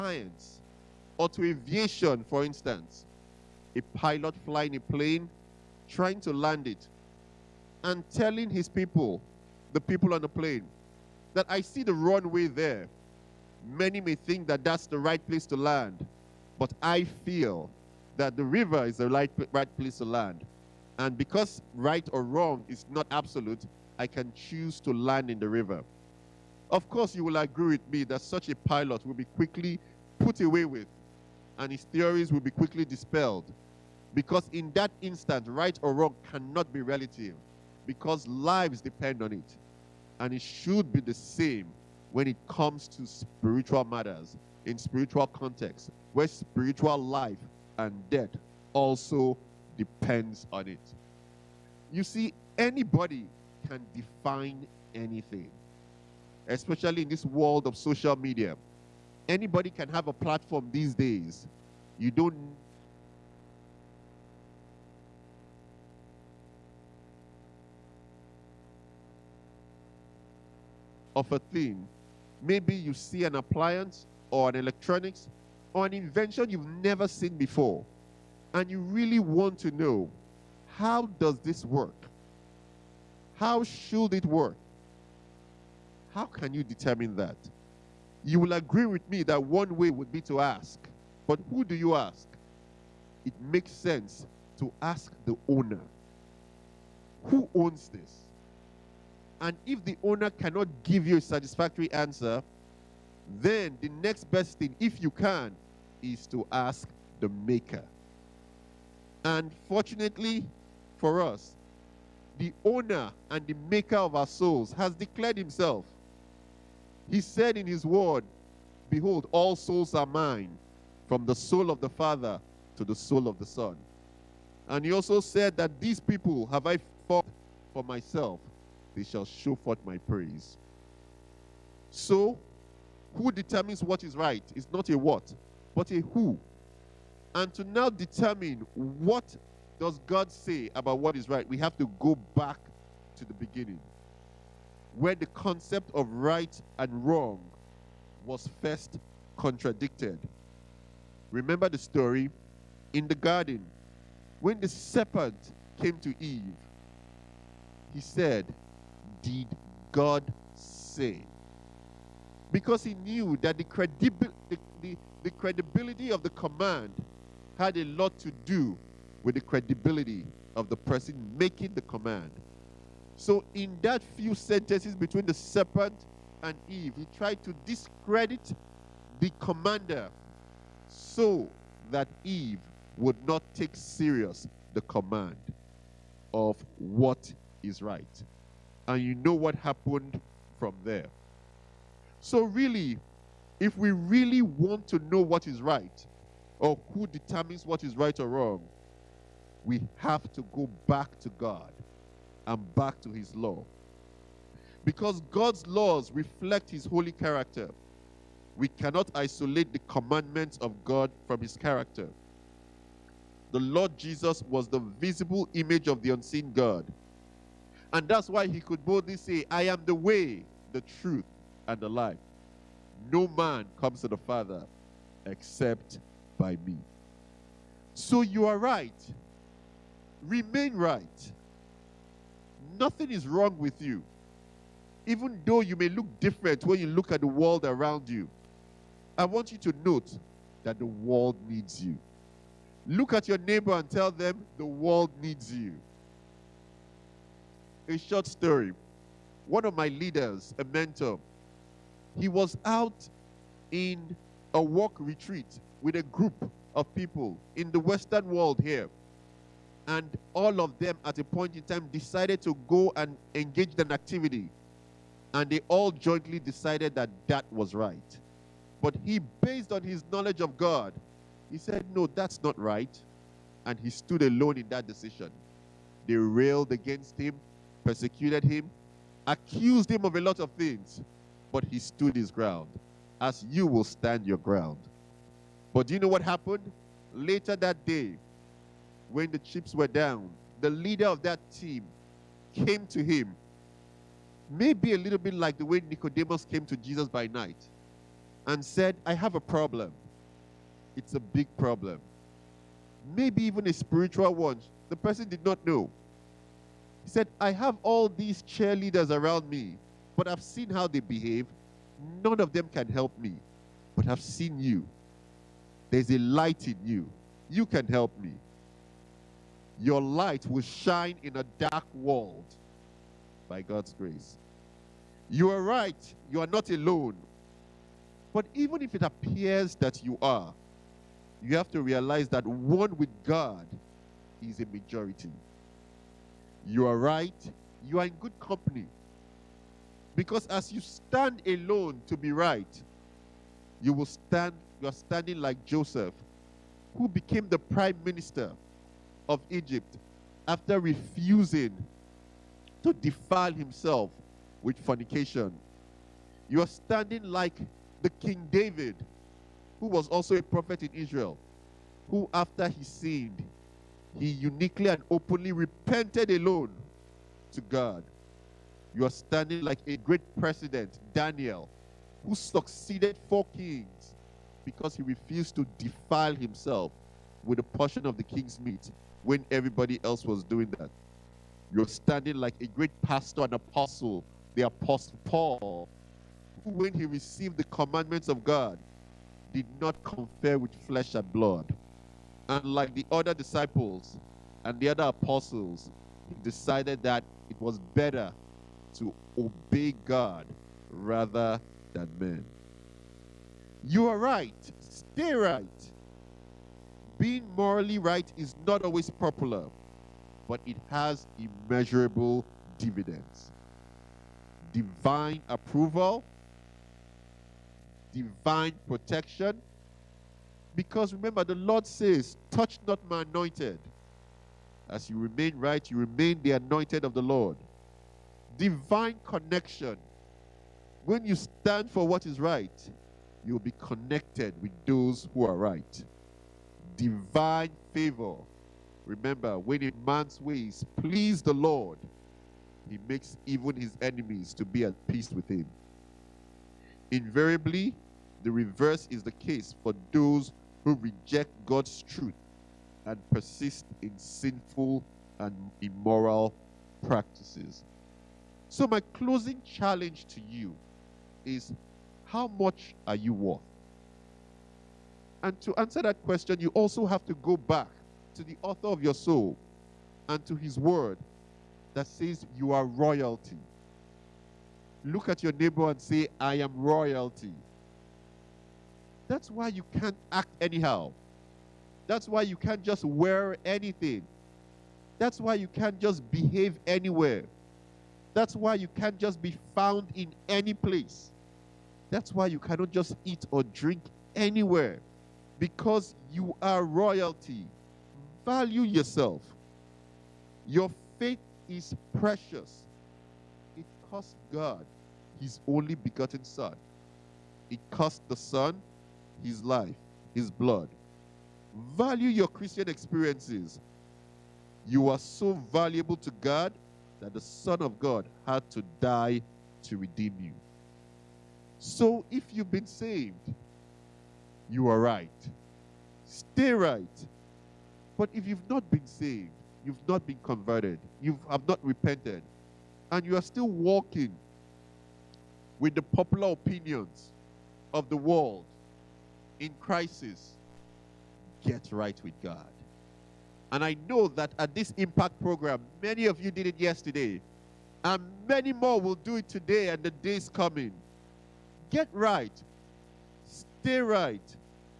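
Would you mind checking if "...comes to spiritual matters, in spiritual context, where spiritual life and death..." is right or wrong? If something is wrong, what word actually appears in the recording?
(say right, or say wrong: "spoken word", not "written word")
right.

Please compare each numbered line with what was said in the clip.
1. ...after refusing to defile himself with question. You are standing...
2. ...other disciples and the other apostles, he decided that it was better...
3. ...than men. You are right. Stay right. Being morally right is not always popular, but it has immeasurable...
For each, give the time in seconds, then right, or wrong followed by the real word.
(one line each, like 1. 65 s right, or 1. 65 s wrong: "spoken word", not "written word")
1. 350 s wrong: "fornication", not "question"
2. 393 s right
3. 401 s right.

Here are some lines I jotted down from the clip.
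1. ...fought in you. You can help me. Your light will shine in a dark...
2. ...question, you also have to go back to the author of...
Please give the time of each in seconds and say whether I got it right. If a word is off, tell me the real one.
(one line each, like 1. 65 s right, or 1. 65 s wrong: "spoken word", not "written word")
1. 316 s wrong: "light", not "fought"
2. 466 s right.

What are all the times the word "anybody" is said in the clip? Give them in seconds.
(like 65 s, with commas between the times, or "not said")
52 s, 59 s.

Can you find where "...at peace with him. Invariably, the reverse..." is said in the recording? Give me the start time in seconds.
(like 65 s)
444 s.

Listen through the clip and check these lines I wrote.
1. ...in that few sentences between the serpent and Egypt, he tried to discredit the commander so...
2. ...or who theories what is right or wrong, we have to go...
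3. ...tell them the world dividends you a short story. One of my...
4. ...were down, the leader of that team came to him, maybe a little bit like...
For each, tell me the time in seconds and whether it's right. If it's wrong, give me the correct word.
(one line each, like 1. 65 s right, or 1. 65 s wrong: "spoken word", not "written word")
1. 173 s wrong: "Eve", not "Egypt"
2. 196 s wrong: "determines", not "theories"
3. 243 s wrong: "needs", not "dividends"
4. 289 s right.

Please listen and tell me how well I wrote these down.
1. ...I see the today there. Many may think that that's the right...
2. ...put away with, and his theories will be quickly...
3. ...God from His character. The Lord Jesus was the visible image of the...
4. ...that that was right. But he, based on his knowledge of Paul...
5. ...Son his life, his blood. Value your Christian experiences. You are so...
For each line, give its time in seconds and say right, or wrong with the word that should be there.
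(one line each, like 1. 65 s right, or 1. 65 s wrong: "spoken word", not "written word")
1. 11 s wrong: "runway", not "today"
2. 30 s right
3. 210 s right
4. 266 s wrong: "God", not "Paul"
5. 508 s right.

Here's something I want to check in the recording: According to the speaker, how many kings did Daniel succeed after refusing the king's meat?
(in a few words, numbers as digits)
4.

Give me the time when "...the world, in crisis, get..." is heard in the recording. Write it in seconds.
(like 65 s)
538 s.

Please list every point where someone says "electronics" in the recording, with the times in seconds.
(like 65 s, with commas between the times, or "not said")
74 s.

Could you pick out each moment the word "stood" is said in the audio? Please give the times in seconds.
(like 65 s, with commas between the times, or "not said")
273 s, 281 s.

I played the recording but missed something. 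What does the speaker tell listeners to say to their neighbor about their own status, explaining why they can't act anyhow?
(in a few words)
I am royalty.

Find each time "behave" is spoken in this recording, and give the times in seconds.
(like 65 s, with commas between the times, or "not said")
310 s, 486 s.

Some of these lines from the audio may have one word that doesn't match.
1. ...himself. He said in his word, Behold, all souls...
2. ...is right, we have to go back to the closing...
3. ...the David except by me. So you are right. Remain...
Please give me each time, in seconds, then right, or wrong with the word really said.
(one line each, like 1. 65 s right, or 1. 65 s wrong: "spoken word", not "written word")
1. 115 s right
2. 141 s wrong: "beginning", not "closing"
3. 224 s wrong: "Father", not "David".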